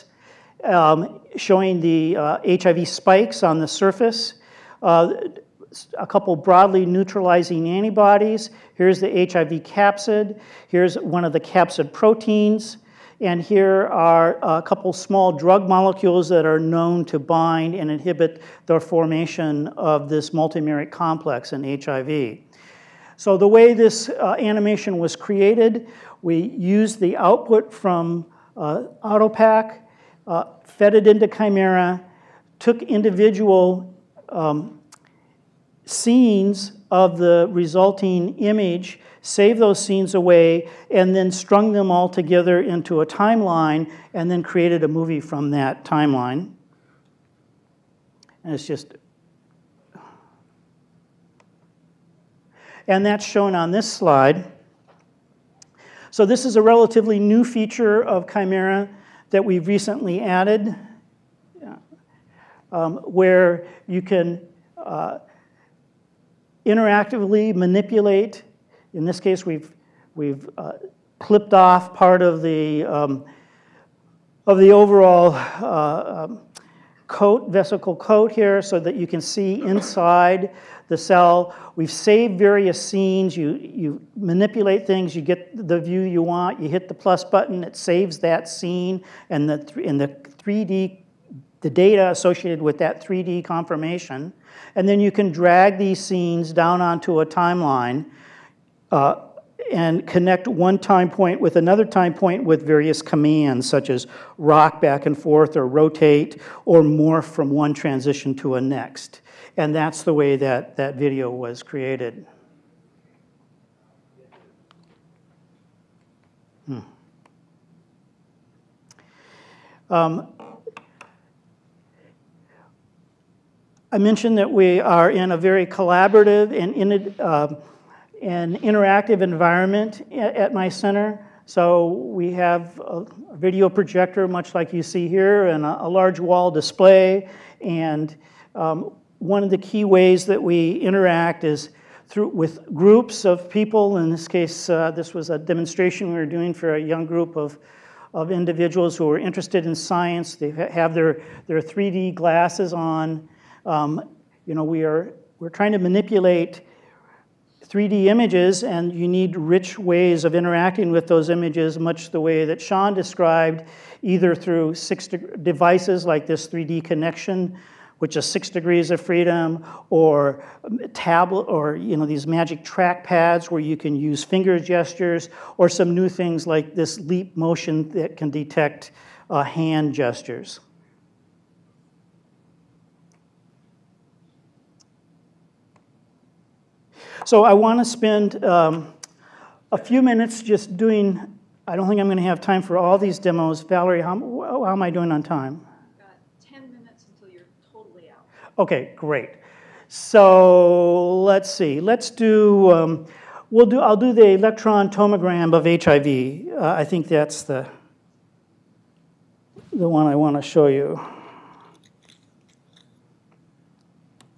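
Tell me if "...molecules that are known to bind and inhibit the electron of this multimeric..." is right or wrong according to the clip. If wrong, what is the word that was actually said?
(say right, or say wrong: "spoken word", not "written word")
wrong: "formation", not "electron".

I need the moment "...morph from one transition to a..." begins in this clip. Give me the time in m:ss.
1:46.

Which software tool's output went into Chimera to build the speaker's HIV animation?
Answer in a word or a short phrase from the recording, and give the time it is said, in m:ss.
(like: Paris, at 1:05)
AutoPack, at 0:29.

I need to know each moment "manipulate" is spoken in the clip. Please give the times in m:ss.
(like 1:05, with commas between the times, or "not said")
1:07, 1:24, 2:35.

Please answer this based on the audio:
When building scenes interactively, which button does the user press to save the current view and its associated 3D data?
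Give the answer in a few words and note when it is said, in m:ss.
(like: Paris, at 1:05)
the plus button, at 1:26.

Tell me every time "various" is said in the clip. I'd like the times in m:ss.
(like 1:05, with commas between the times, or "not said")
1:22, 1:42.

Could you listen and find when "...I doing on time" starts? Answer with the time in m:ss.
3:14.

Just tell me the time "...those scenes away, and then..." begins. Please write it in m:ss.
0:39.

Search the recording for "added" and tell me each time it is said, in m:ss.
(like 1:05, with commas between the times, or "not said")
1:00.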